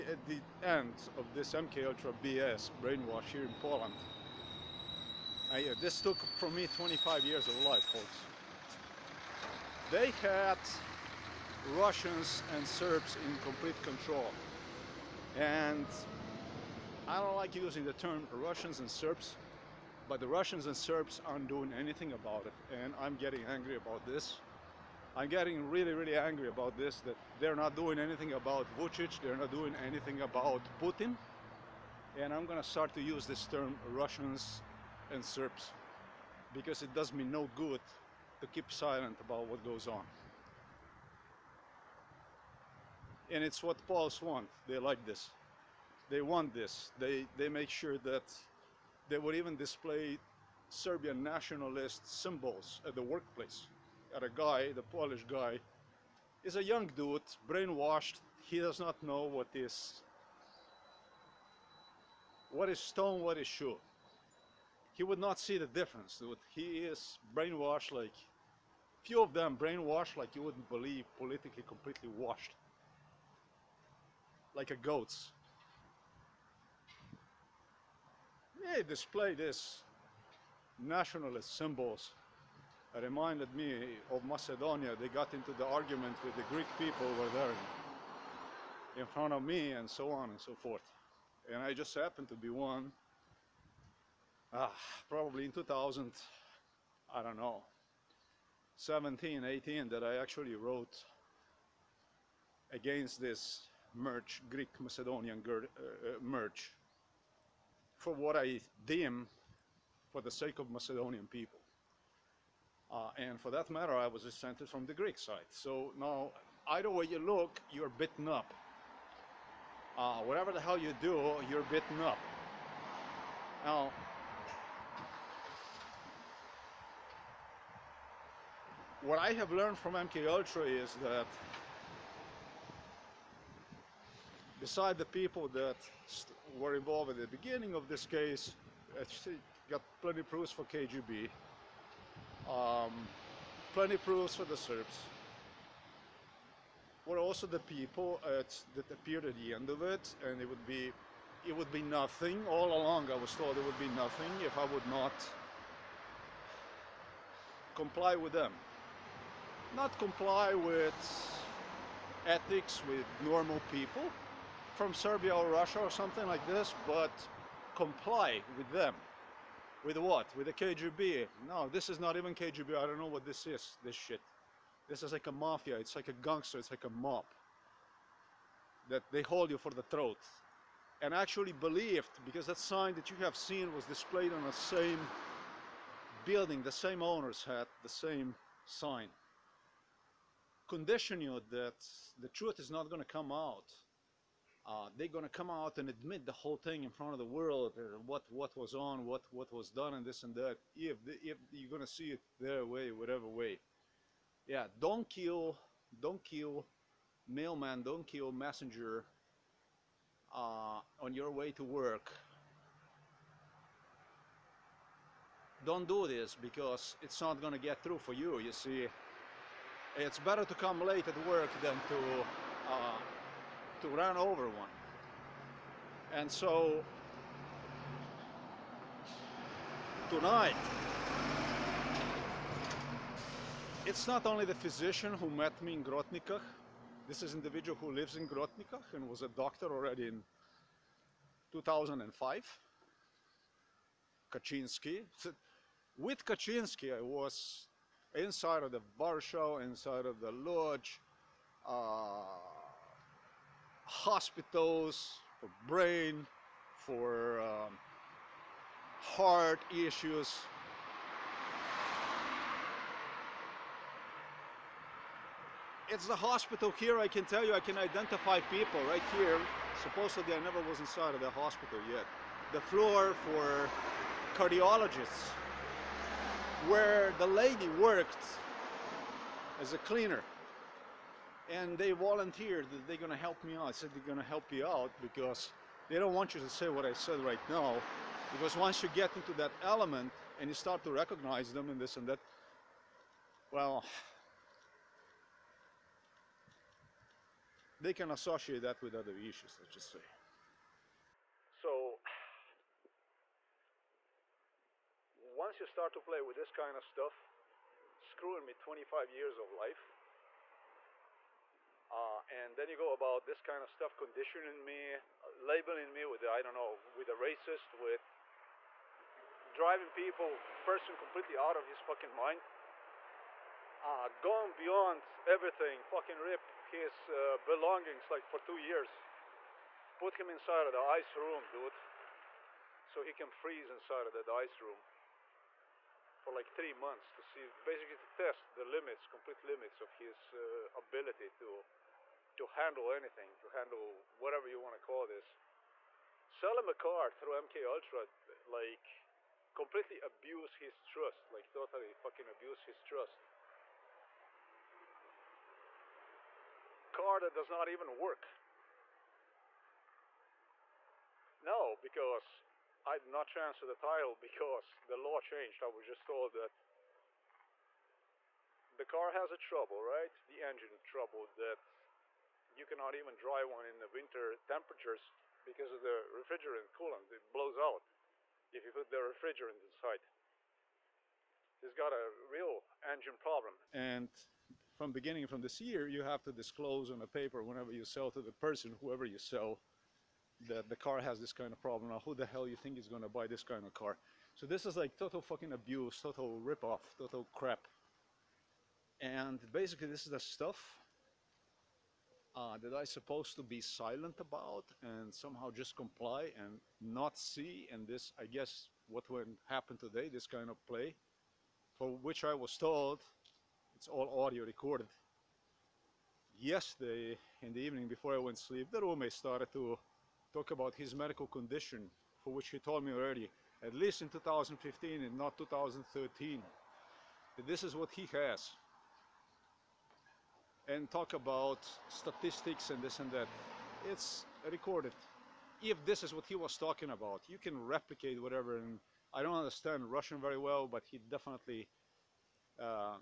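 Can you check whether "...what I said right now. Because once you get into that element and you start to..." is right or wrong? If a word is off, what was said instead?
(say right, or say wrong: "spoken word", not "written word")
right.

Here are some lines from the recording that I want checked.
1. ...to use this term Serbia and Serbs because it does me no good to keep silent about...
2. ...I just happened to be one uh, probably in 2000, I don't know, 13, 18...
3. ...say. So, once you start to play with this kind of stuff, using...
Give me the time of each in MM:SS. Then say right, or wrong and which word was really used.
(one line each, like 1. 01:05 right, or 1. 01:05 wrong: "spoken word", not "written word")
1. 00:32 wrong: "Russians", not "Serbia"
2. 01:31 wrong: "17", not "13"
3. 04:59 wrong: "screwing", not "using".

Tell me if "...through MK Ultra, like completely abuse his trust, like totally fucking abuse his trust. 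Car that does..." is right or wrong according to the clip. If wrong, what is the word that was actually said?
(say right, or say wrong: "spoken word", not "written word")
right.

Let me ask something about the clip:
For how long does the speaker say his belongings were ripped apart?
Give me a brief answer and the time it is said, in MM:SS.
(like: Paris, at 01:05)
2 years, at 05:28.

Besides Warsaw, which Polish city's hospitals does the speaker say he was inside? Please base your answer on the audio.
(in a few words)
Lodz.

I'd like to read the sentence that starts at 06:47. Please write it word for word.
And this, I guess, what went happen today, this kind of play, for which I was told it's all audio recorded.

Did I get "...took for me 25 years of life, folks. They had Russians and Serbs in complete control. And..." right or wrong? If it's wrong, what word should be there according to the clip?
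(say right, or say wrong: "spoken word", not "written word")
right.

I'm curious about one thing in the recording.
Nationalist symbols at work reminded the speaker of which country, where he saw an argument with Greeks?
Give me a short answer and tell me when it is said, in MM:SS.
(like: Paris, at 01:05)
Macedonia, at 01:24.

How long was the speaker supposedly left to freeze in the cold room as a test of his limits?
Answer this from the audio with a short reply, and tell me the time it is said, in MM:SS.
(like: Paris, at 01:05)
3 months, at 05:36.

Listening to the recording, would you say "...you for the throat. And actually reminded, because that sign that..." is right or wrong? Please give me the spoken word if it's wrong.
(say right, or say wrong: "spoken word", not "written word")
wrong: "believed", not "reminded".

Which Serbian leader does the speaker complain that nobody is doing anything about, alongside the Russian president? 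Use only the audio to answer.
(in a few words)
Vucic.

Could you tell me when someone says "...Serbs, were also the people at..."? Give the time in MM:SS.
02:24.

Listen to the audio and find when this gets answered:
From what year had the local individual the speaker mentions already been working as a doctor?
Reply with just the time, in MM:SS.
04:01.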